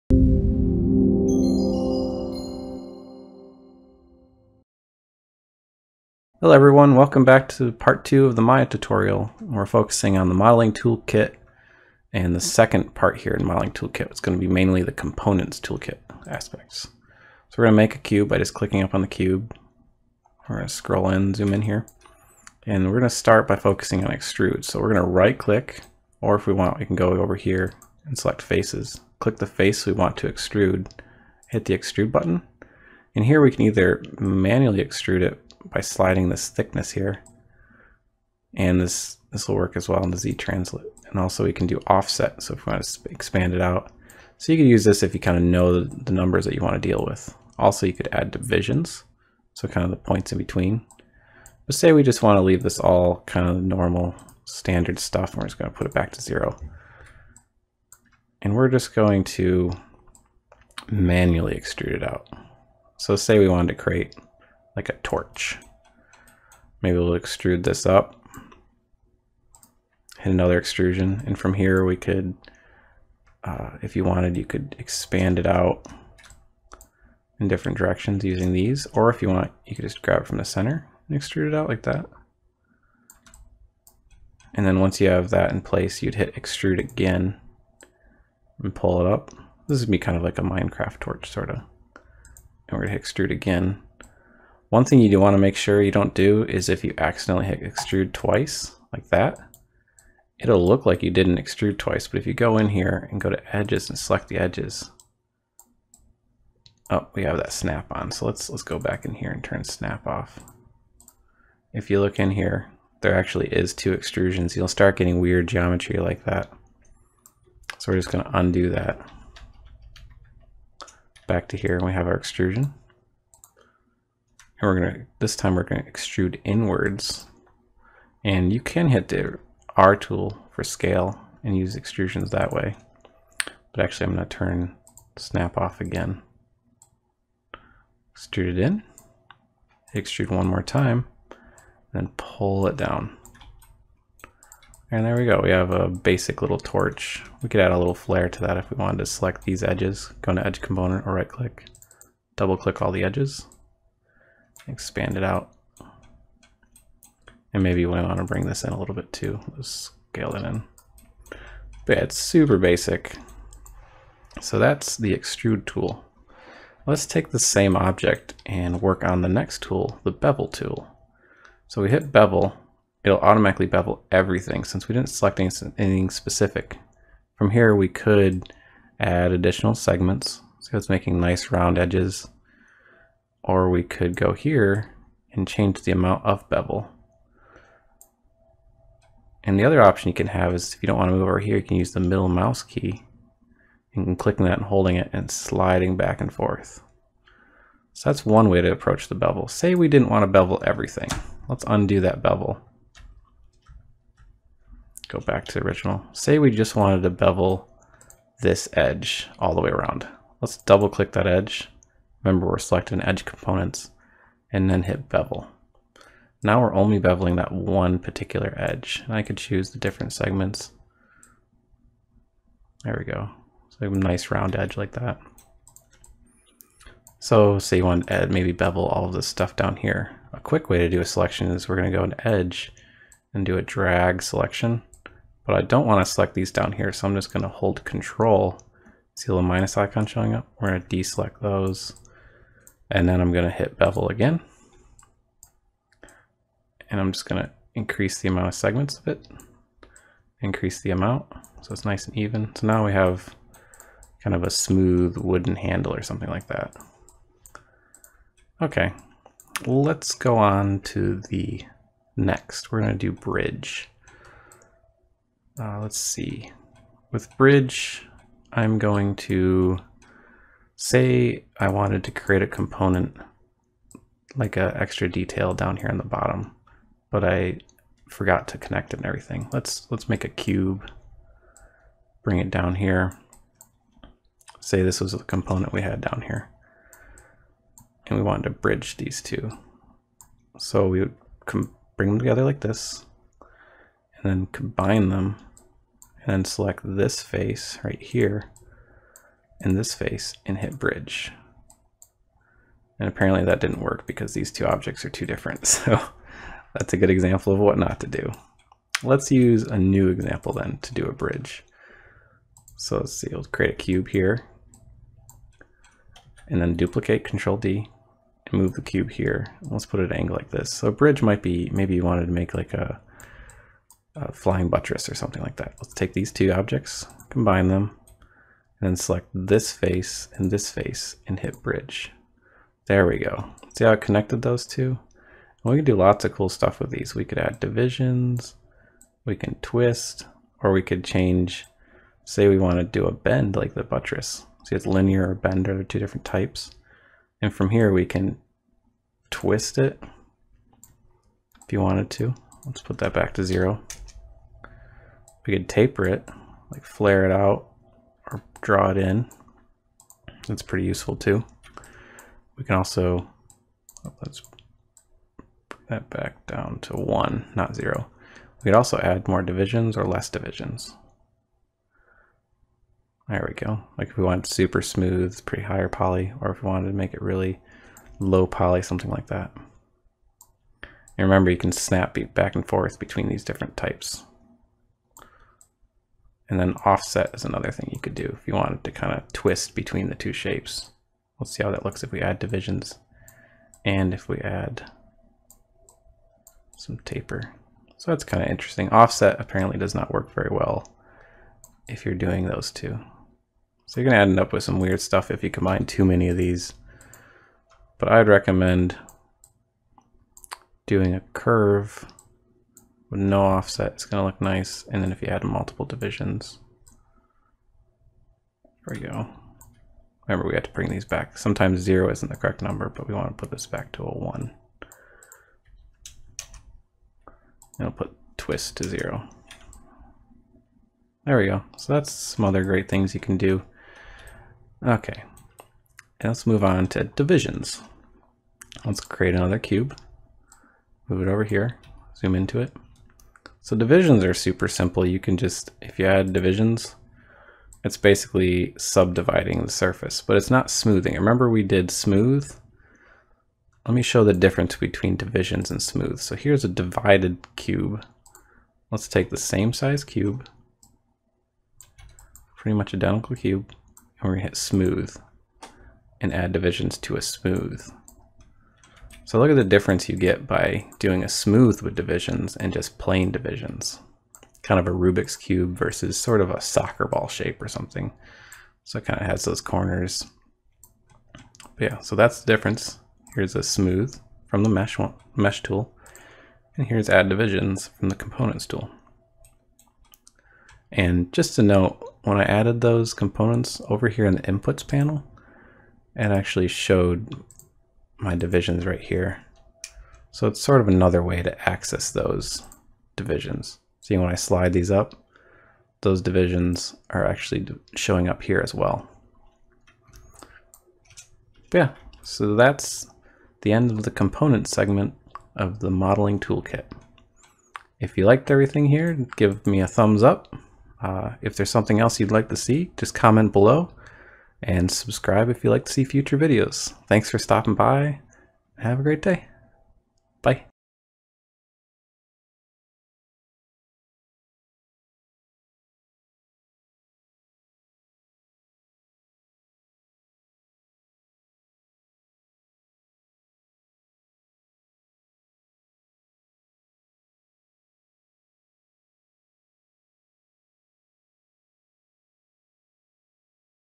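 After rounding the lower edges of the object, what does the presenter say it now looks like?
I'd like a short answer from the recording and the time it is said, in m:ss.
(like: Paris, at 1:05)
Wooden handle, at 4:15.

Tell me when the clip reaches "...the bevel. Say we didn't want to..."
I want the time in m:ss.
3:19.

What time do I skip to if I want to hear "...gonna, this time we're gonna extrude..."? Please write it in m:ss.
2:04.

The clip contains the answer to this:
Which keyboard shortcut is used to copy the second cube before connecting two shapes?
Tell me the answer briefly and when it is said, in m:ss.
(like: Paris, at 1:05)
Control D, at 5:17.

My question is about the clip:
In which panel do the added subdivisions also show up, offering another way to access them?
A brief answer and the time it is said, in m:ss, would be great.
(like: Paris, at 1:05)
Inputs panel, at 8:14.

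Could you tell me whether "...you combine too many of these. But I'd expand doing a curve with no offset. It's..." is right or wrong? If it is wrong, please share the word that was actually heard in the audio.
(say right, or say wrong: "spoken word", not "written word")
wrong: "recommend", not "expand".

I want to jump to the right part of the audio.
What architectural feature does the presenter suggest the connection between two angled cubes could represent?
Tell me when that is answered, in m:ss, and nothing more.
5:24.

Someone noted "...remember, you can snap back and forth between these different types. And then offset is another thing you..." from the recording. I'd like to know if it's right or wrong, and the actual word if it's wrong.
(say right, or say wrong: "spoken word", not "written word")
right.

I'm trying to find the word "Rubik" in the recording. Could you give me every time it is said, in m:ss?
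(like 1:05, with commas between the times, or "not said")
7:54.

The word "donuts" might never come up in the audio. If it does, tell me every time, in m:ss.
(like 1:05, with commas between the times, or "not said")
not said.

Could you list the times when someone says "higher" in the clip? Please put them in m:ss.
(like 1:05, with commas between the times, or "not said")
6:15.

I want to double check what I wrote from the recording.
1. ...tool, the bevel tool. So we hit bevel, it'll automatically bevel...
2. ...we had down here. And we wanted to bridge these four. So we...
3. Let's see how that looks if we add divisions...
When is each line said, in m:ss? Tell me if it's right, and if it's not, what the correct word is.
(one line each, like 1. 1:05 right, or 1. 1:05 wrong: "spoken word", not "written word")
1. 2:49 right
2. 4:45 wrong: "two", not "four"
3. 6:31 right.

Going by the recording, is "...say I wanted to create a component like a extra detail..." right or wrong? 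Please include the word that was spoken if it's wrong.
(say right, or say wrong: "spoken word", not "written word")
right.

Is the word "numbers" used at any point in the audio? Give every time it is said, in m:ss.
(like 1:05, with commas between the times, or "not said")
0:46, 7:02.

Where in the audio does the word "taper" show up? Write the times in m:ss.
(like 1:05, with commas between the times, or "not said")
5:55, 6:37.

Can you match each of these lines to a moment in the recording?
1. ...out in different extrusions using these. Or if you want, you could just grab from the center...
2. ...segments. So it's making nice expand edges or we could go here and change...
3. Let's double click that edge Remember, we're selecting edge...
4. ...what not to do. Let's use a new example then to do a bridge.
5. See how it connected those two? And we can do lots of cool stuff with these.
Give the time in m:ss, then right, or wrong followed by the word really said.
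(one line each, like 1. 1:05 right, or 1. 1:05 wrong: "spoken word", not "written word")
1. 1:15 wrong: "directions", not "extrusions"
2. 2:59 wrong: "round", not "expand"
3. 3:30 right
4. 5:07 right
5. 5:33 right.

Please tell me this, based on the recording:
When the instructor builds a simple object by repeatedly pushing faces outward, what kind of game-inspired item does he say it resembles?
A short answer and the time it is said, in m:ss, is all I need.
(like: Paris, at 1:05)
Minecraft torch, at 1:30.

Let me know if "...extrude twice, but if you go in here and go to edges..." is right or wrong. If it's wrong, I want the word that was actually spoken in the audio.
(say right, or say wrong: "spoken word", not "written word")
right.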